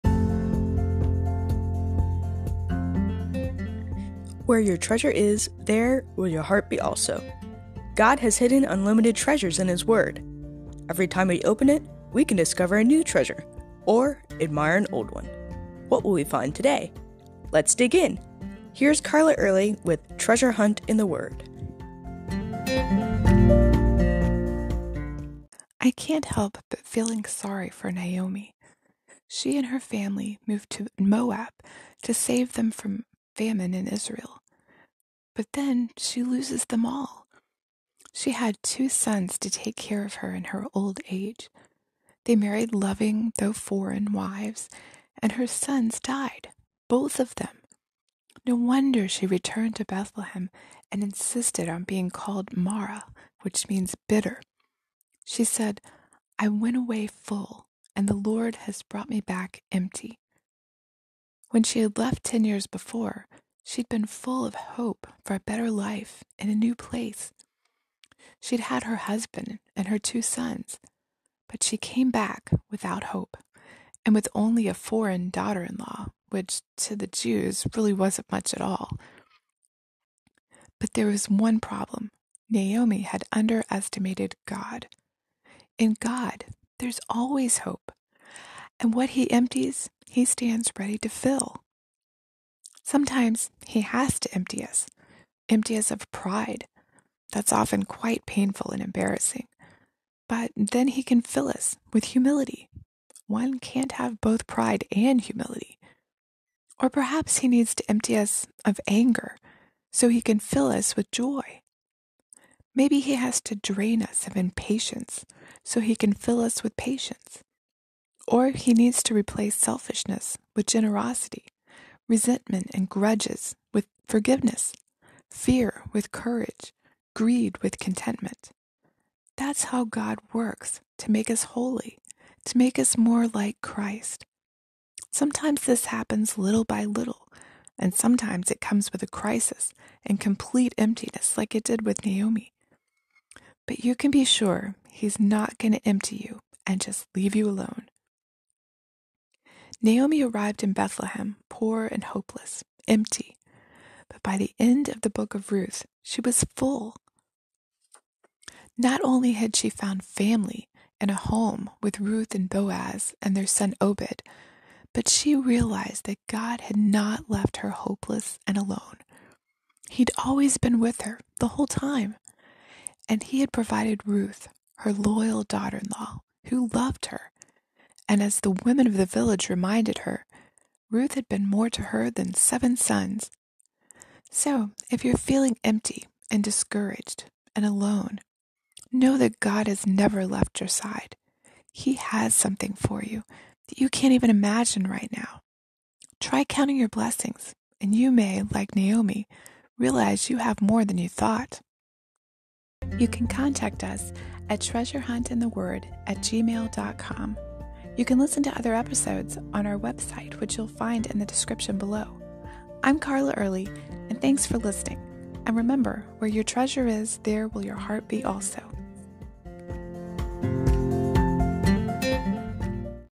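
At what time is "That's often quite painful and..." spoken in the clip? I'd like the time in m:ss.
1:37.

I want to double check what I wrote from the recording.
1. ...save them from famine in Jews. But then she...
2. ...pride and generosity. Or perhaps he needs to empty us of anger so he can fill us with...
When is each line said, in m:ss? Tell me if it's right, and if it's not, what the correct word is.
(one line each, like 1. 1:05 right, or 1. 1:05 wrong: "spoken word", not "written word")
1. 0:32 wrong: "Israel", not "Jews"
2. 1:44 wrong: "humility", not "generosity".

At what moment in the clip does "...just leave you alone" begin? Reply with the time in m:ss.
2:26.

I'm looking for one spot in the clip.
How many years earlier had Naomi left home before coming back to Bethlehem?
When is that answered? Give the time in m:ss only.
1:02.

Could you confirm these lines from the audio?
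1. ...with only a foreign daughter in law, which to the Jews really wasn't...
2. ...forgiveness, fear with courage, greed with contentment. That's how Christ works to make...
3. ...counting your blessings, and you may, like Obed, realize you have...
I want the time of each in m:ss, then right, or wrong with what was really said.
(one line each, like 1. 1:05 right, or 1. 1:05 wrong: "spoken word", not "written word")
1. 1:14 right
2. 2:04 wrong: "God", not "Christ"
3. 3:16 wrong: "Naomi", not "Obed".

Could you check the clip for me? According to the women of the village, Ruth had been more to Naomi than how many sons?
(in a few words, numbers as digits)
7.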